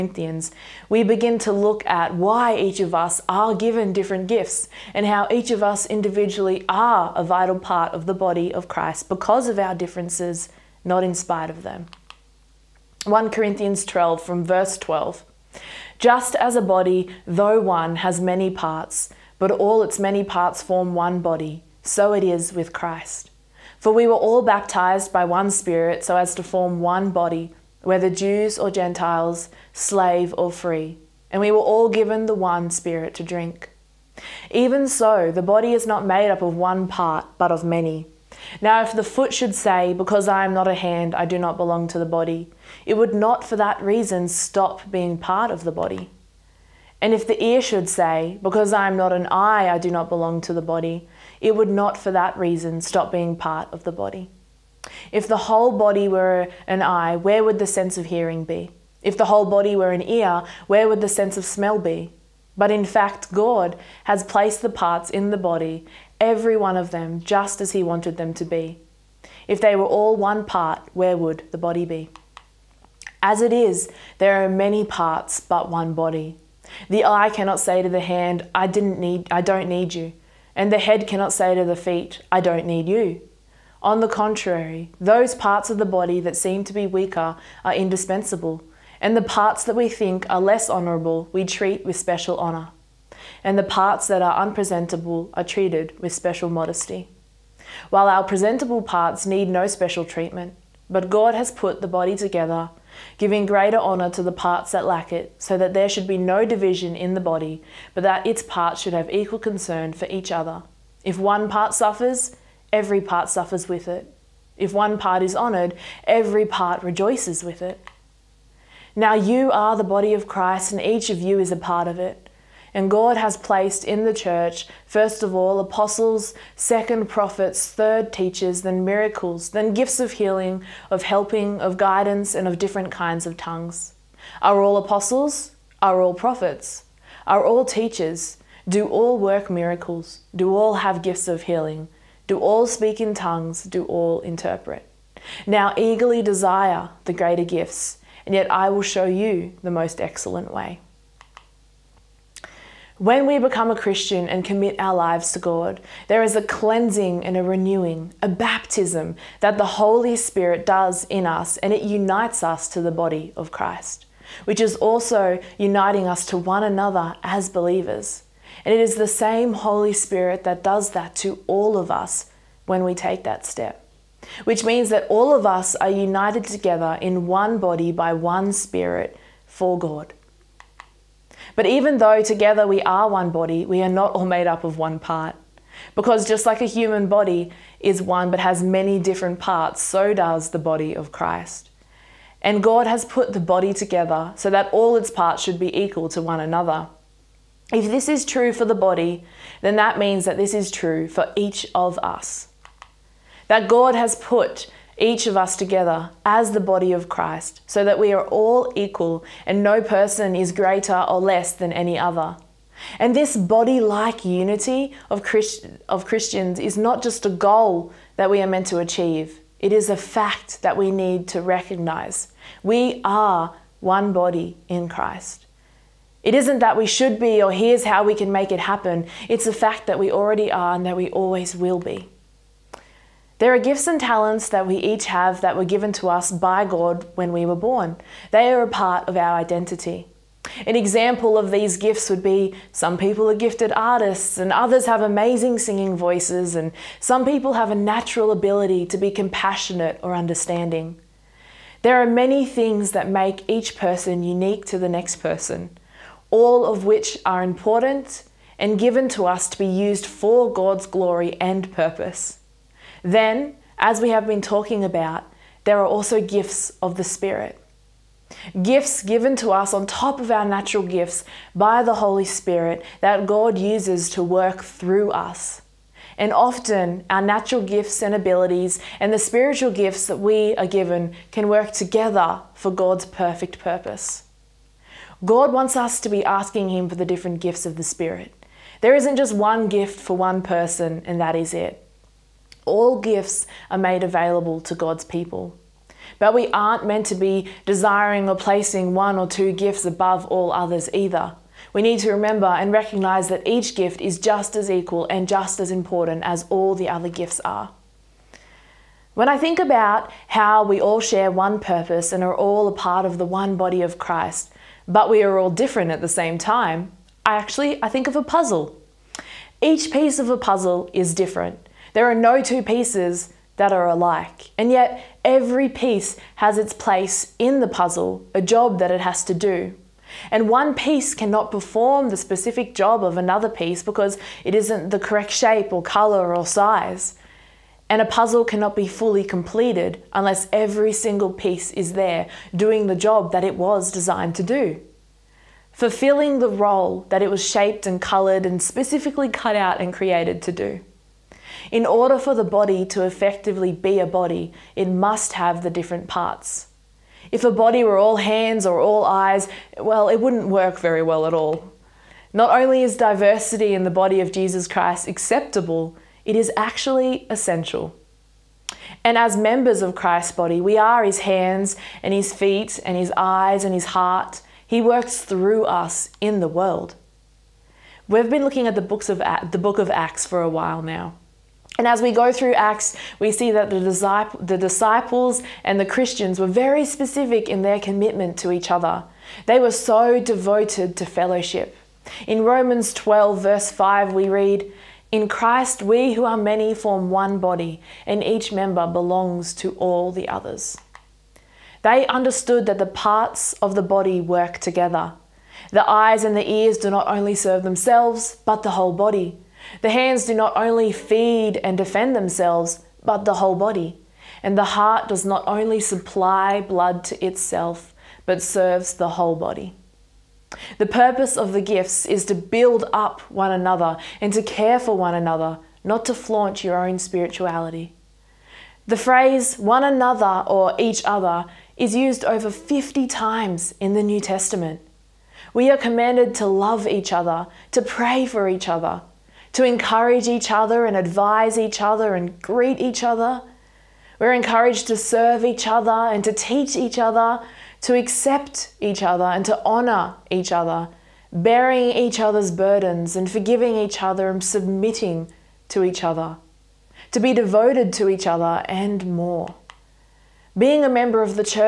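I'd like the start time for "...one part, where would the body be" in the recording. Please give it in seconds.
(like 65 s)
70 s.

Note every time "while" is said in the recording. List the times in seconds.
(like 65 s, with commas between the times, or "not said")
97 s, 380 s.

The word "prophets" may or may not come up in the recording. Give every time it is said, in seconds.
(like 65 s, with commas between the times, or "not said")
127 s, 136 s.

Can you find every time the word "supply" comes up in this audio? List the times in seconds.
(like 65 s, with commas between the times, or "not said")
415 s.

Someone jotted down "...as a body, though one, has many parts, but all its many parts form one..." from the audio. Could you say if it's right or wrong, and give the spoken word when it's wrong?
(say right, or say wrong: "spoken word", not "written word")
right.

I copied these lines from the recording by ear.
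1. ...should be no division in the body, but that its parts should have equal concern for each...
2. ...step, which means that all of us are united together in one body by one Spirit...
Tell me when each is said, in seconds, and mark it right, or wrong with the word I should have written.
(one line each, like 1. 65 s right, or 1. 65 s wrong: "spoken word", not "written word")
1. 105 s right
2. 173 s right.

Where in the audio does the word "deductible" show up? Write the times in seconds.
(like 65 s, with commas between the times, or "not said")
not said.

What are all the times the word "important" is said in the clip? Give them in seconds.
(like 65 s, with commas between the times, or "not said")
257 s, 305 s.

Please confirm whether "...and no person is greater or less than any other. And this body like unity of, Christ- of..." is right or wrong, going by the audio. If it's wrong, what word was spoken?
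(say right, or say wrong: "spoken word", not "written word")
right.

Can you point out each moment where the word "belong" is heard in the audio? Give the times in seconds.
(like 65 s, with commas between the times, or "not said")
41 s, 50 s, 398 s.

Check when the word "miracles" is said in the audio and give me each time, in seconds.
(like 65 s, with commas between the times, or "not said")
128 s, 139 s.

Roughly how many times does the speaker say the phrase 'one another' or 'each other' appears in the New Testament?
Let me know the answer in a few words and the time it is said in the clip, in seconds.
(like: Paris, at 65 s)
Over 50, at 432 s.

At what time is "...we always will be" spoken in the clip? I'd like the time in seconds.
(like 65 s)
230 s.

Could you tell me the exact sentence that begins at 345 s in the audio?
Fulfilling the role that it was shaped and colored and specifically cut out and created to do.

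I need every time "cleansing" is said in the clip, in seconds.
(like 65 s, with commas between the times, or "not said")
156 s.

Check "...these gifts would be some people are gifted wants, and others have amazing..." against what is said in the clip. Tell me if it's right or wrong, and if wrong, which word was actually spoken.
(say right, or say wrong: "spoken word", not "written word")
wrong: "artists", not "wants".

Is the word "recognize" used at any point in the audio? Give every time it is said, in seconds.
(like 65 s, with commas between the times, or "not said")
221 s, 302 s.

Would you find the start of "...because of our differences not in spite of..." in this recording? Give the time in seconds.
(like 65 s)
9 s.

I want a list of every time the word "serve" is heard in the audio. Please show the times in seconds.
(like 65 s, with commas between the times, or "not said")
407 s, 418 s, 444 s.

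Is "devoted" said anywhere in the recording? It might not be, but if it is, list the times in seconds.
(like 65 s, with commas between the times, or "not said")
390 s, 457 s.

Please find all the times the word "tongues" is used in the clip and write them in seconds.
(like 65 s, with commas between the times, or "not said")
133 s, 143 s.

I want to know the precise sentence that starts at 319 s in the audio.
Each piece of a puzzle is different.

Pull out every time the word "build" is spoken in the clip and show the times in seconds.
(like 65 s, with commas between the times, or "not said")
422 s.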